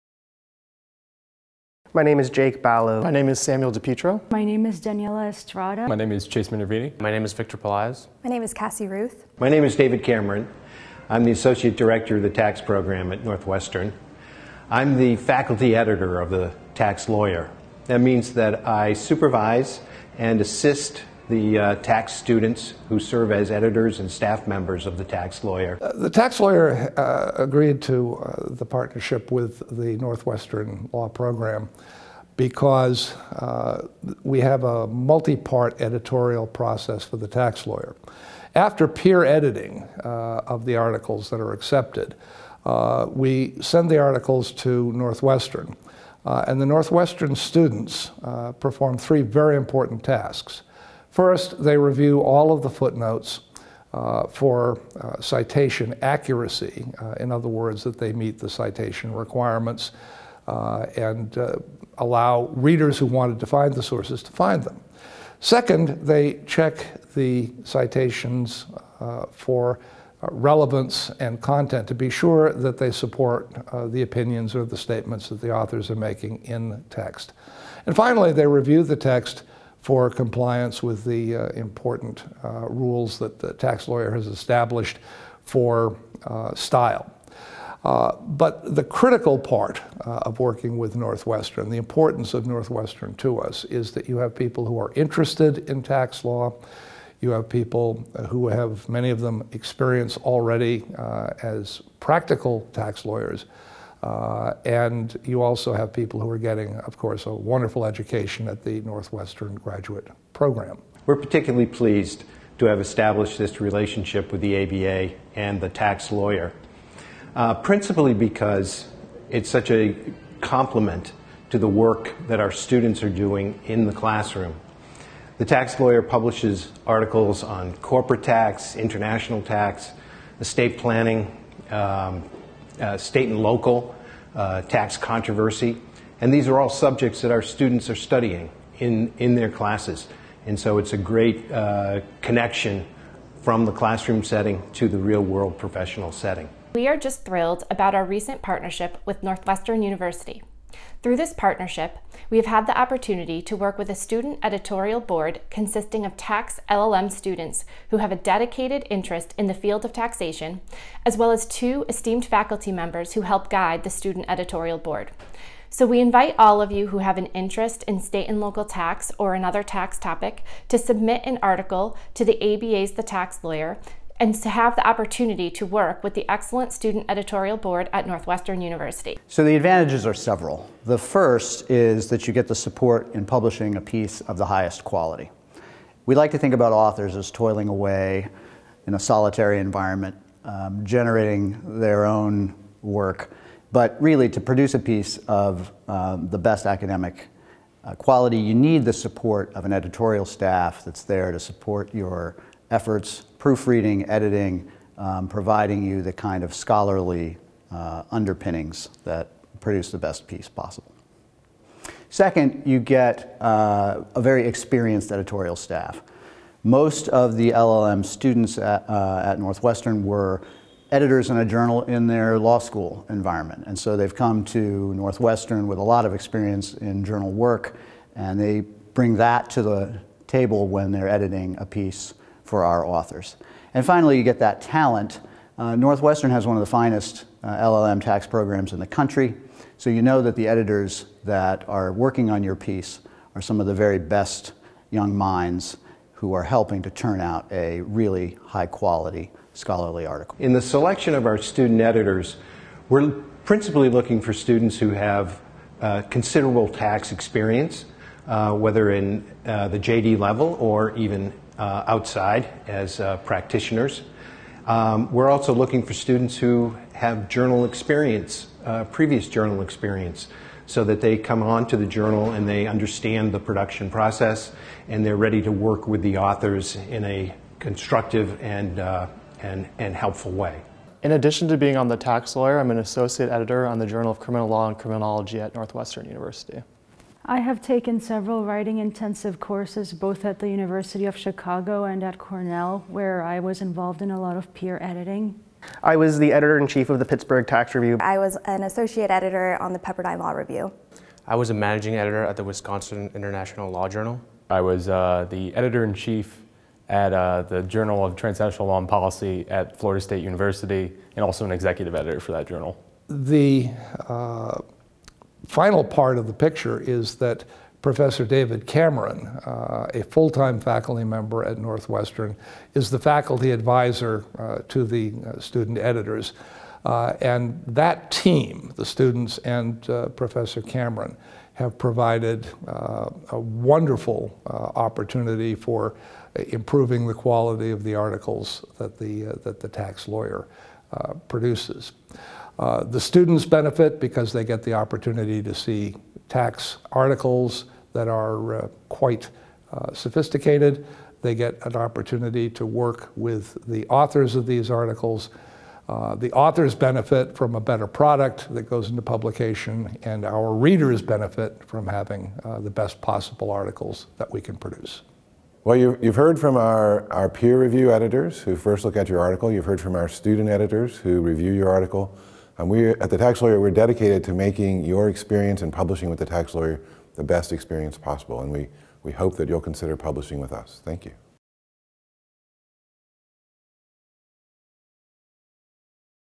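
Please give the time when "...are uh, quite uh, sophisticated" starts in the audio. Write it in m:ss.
5:48.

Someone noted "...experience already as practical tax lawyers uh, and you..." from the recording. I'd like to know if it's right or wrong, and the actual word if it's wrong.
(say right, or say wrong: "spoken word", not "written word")
right.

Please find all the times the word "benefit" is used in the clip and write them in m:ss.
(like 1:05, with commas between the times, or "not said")
5:43, 5:56, 6:01.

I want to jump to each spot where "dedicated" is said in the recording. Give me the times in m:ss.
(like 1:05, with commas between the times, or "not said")
2:38, 6:13.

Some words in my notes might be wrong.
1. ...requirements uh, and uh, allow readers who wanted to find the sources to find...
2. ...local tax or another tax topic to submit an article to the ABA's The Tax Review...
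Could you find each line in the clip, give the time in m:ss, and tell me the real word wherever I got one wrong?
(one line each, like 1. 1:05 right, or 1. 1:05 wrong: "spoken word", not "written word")
1. 0:59 right
2. 2:48 wrong: "Lawyer", not "Review".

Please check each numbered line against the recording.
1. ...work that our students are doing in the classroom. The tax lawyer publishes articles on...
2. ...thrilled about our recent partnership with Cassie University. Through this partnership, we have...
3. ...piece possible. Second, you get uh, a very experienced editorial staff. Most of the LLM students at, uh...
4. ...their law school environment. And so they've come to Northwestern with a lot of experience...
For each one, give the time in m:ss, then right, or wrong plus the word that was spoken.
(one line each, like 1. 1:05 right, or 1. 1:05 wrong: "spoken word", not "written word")
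1. 2:01 right
2. 2:27 wrong: "Northwestern", not "Cassie"
3. 3:30 right
4. 3:42 right.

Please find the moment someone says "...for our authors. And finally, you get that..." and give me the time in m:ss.
3:52.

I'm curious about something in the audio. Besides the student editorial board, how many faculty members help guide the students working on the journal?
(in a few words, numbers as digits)
2.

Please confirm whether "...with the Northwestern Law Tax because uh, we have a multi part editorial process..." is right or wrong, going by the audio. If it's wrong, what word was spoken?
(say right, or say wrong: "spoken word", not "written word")
wrong: "Program", not "Tax".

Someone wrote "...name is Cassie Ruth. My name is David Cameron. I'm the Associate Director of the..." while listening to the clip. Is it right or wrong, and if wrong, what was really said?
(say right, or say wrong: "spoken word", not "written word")
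right.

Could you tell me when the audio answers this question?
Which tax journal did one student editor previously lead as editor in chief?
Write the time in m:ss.
4:57.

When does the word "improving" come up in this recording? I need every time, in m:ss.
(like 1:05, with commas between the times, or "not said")
5:36.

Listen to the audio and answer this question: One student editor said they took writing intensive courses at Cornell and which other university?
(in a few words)
University of Chicago.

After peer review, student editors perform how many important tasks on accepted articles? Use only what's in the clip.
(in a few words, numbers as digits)
3.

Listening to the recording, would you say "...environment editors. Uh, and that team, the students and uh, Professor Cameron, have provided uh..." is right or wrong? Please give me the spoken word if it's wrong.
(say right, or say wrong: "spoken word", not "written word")
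wrong: "student", not "environment".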